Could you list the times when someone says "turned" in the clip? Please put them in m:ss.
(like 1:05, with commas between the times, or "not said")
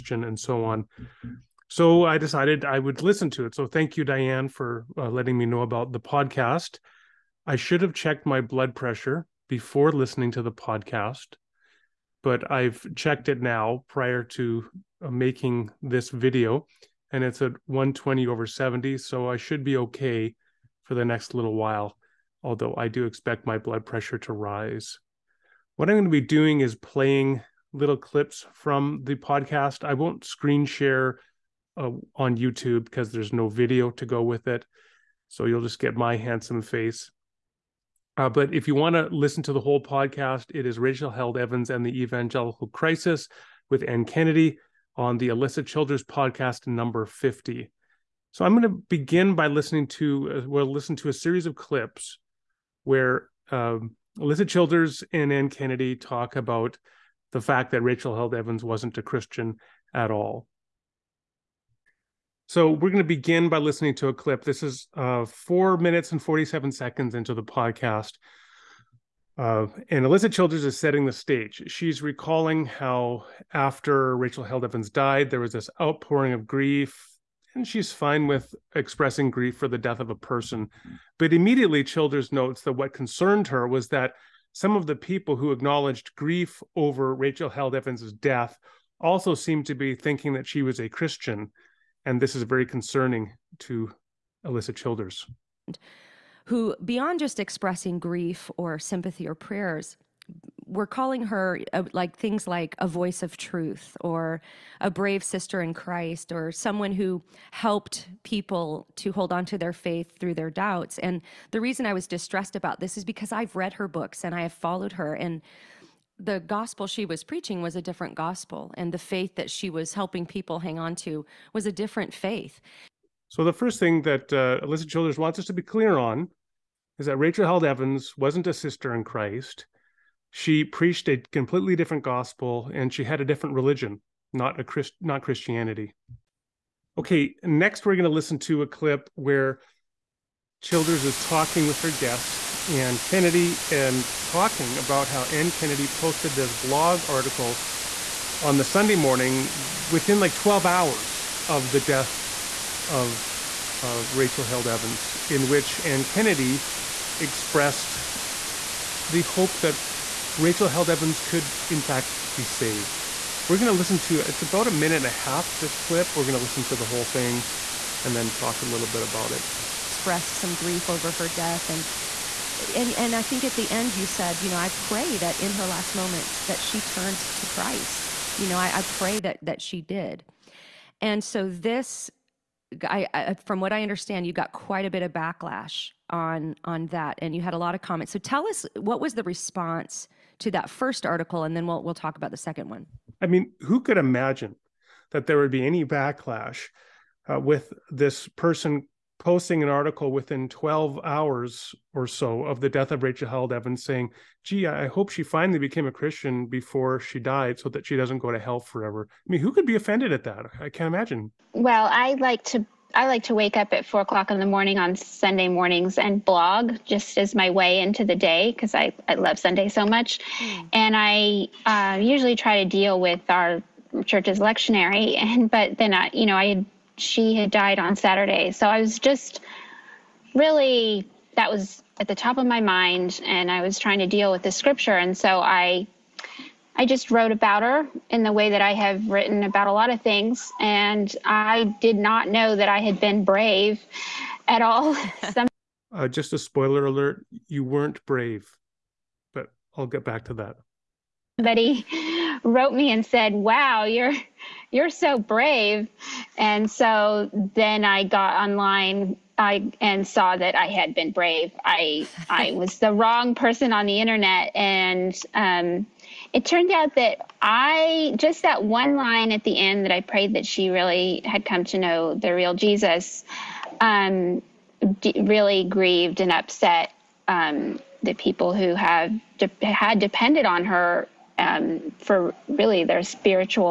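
2:56, 4:26.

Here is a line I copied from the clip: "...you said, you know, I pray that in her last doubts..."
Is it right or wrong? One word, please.
wrong.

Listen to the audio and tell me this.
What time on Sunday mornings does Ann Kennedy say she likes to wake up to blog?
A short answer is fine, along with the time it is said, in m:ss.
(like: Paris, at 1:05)
4 o'clock, at 3:33.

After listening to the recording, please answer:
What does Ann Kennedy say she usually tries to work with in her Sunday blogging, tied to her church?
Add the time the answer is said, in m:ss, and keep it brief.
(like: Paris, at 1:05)
lectionary, at 3:44.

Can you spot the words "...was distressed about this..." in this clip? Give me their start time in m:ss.
1:51.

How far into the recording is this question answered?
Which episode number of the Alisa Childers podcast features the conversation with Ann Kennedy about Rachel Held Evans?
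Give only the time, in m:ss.
0:46.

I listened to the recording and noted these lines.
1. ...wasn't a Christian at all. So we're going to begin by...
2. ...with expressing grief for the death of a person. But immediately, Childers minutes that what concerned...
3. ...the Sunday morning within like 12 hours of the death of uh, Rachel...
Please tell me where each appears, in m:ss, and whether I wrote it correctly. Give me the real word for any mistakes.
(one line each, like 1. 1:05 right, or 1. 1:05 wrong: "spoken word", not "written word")
1. 0:58 right
2. 1:18 wrong: "notes", not "minutes"
3. 2:28 right.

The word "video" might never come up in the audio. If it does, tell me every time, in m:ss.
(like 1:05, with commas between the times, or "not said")
0:16, 0:33.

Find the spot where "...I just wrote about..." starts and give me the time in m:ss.
3:56.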